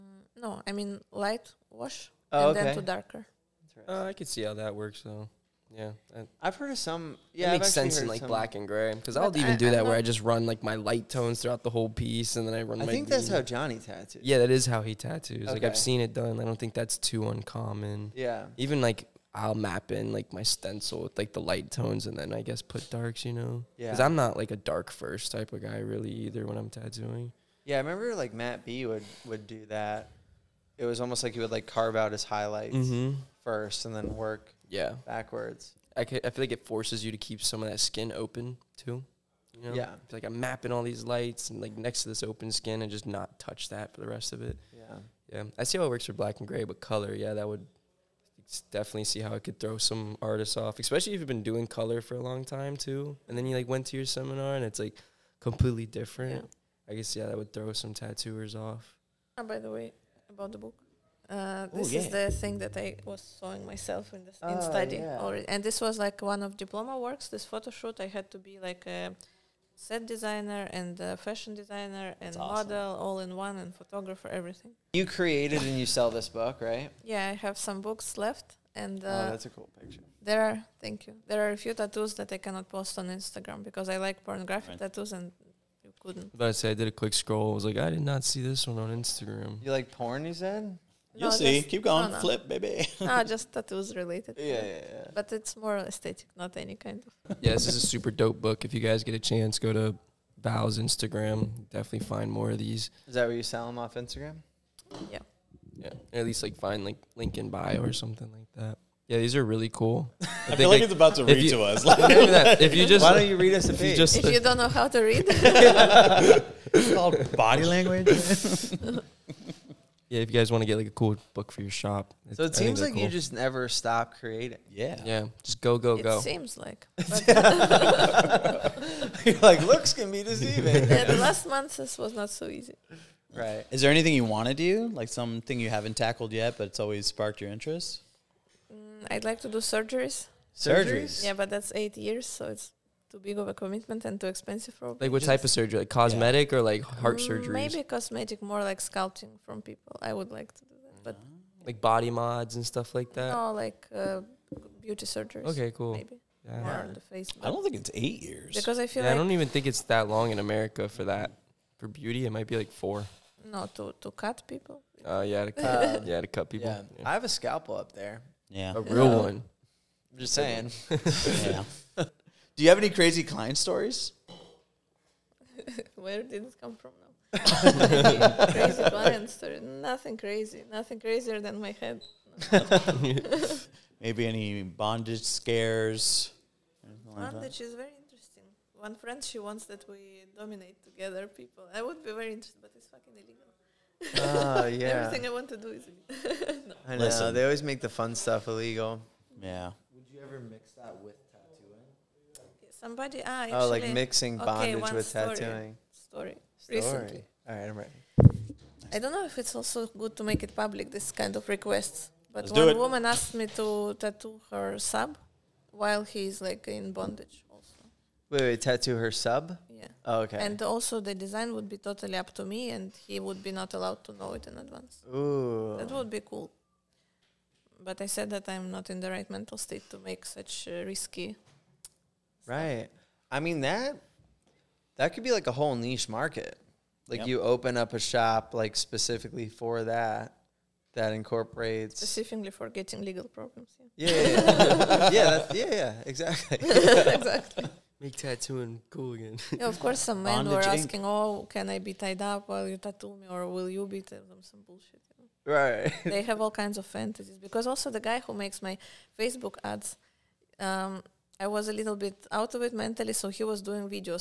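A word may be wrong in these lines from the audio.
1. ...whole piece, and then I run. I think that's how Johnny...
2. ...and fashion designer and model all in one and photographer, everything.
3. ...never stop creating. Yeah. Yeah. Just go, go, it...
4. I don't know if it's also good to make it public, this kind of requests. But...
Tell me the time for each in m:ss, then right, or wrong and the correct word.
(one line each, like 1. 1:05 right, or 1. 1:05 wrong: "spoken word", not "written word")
1. 0:11 right
2. 1:10 right
3. 2:03 right
4. 3:28 right.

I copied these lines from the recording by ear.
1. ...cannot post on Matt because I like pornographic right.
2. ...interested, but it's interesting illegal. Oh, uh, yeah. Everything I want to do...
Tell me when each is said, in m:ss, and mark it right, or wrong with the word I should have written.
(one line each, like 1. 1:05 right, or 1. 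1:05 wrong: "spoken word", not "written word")
1. 1:22 wrong: "Instagram", not "Matt"
2. 3:12 wrong: "fucking", not "interesting".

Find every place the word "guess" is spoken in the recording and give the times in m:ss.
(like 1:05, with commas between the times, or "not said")
0:22, 0:56.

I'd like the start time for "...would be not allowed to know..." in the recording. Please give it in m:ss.
3:43.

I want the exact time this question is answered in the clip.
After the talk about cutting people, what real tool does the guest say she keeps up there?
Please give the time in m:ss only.
2:47.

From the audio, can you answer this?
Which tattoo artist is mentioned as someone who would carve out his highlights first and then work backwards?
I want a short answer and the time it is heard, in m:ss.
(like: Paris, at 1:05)
Matt B, at 0:28.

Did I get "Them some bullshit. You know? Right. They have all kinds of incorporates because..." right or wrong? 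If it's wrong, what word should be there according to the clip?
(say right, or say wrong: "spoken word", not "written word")
wrong: "fantasies", not "incorporates".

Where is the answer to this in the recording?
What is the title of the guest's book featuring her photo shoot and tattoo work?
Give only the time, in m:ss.
1:57.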